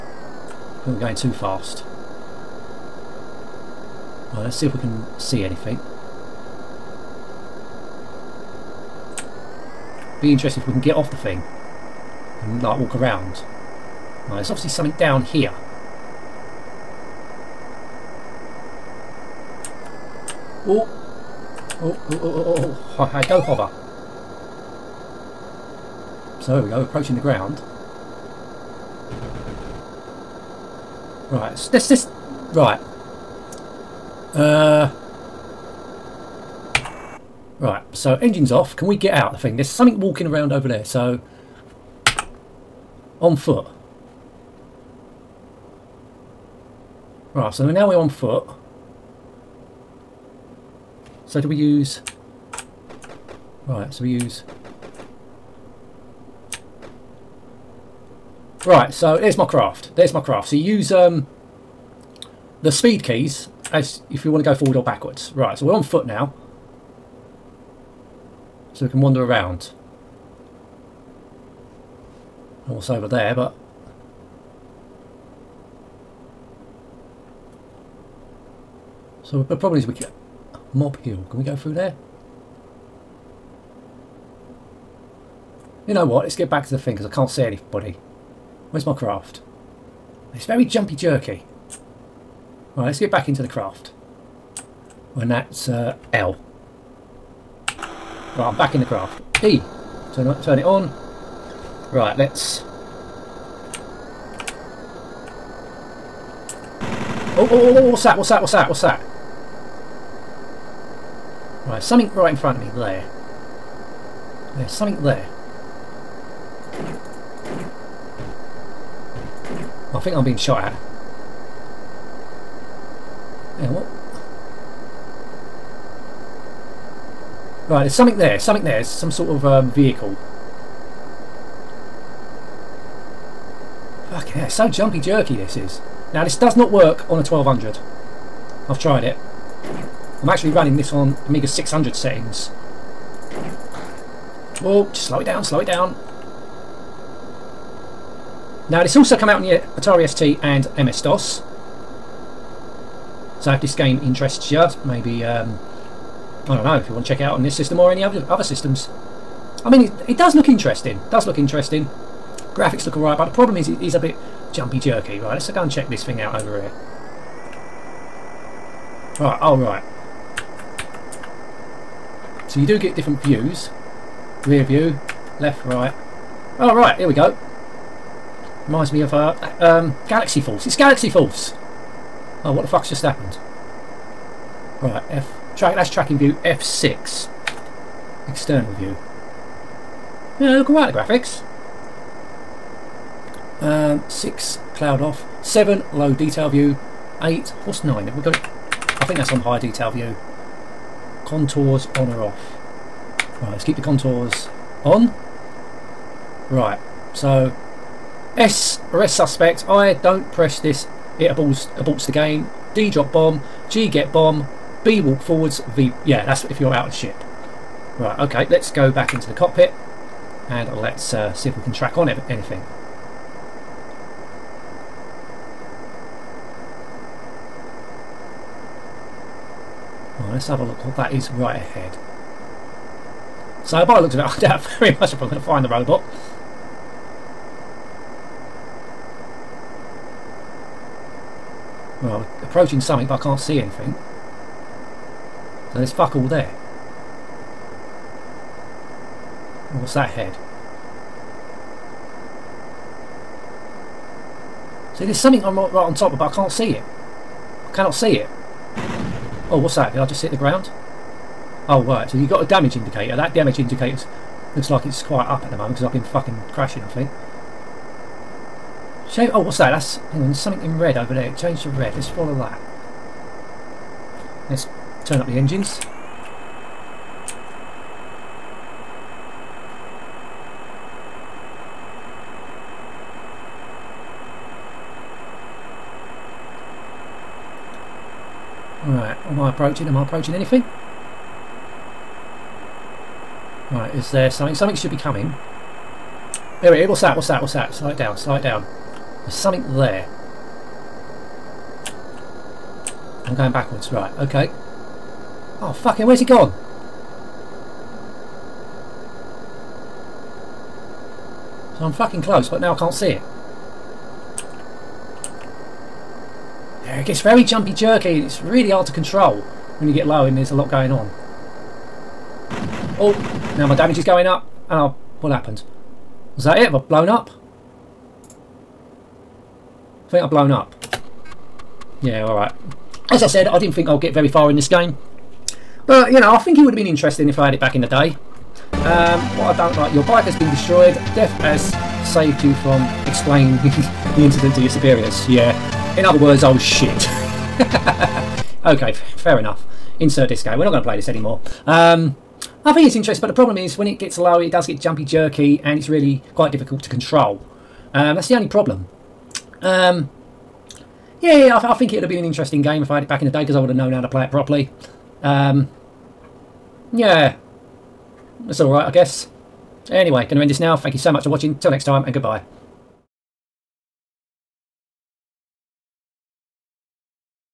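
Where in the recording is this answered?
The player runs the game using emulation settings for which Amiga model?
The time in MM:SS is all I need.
02:21.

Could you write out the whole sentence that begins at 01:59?
I think I'm being shot at.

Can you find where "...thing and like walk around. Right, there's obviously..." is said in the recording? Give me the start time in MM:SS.
00:11.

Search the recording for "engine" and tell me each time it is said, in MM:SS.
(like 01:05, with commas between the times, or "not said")
00:38, 04:35.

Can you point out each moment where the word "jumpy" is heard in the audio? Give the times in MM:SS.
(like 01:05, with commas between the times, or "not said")
01:30, 02:14, 02:44, 05:17, 05:54.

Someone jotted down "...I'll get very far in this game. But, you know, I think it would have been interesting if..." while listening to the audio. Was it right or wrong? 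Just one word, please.
right.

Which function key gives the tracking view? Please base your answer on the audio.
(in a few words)
F6.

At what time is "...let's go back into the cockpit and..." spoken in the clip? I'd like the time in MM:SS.
03:38.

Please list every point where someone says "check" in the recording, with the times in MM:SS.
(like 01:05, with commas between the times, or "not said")
02:37, 02:45.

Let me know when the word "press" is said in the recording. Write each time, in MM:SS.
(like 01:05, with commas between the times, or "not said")
03:30.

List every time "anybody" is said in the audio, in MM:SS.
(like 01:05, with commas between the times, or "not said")
01:27.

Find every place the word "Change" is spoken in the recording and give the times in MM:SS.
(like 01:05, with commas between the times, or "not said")
04:31.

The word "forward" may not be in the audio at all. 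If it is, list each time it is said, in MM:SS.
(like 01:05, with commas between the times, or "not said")
01:04, 03:35.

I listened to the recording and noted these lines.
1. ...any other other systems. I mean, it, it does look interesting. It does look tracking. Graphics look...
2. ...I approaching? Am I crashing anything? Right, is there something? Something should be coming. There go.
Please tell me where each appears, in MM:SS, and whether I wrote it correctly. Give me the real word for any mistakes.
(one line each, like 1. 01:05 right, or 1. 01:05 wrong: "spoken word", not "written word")
1. 02:37 wrong: "interesting", not "tracking"
2. 04:49 wrong: "approaching", not "crashing".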